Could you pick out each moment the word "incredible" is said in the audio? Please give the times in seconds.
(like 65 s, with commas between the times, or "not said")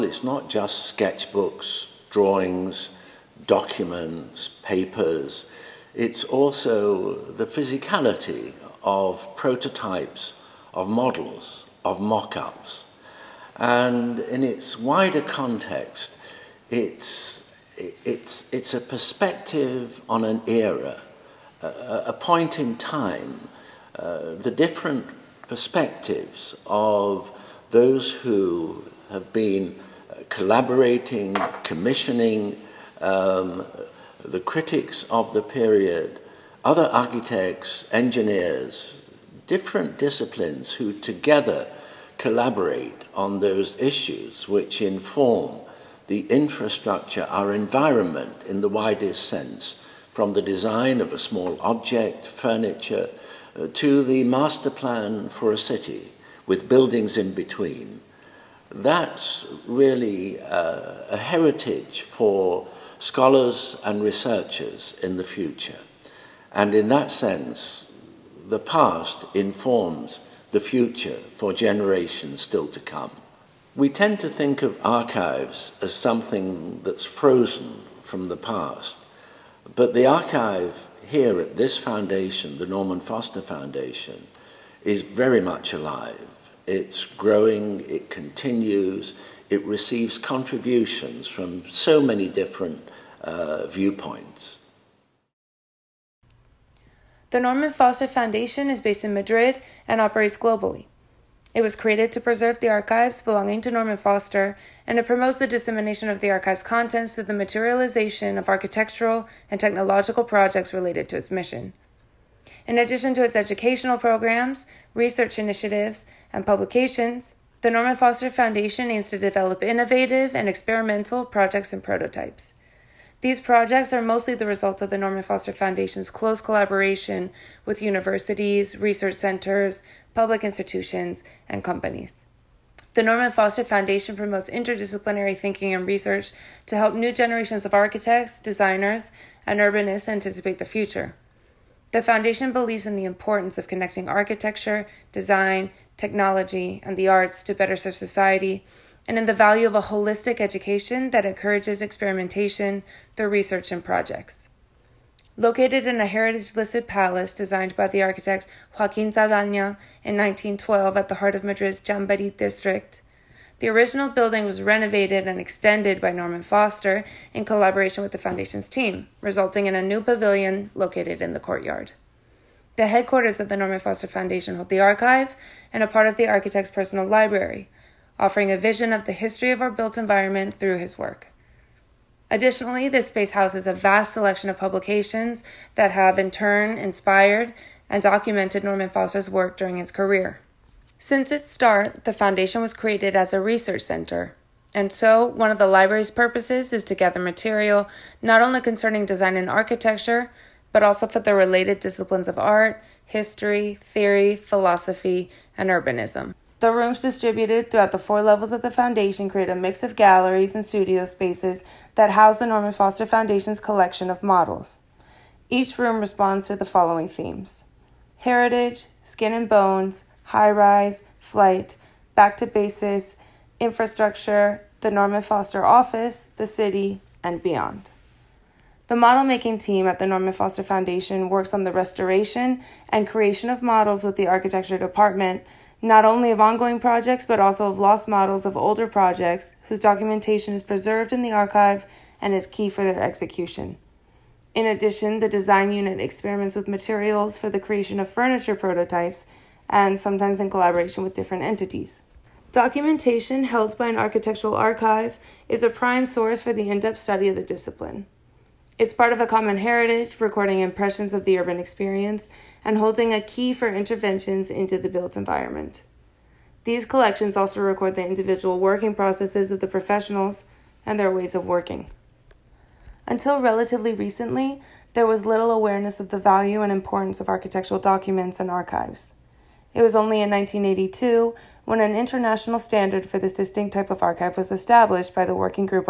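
not said.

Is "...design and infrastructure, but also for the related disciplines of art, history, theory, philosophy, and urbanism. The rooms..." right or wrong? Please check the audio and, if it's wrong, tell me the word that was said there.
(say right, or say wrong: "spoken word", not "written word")
wrong: "architecture", not "infrastructure".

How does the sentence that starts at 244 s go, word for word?
In addition, the design unit experiments with materials for the creation of furniture prototypes and sometimes in collaboration with different entities.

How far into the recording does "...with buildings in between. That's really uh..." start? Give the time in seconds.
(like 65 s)
56 s.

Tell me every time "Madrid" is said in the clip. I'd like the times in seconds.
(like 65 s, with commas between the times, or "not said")
99 s, 161 s.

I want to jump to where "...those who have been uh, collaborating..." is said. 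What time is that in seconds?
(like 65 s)
27 s.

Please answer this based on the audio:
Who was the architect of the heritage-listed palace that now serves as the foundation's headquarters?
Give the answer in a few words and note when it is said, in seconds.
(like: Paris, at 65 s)
Joaquin Saldaña, at 158 s.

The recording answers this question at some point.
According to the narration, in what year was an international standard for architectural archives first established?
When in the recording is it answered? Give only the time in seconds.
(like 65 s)
280 s.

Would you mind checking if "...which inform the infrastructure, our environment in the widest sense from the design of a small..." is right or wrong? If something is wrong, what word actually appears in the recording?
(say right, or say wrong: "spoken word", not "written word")
right.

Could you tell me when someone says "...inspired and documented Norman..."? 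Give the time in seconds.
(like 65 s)
186 s.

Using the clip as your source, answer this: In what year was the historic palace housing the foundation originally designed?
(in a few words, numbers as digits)
1912.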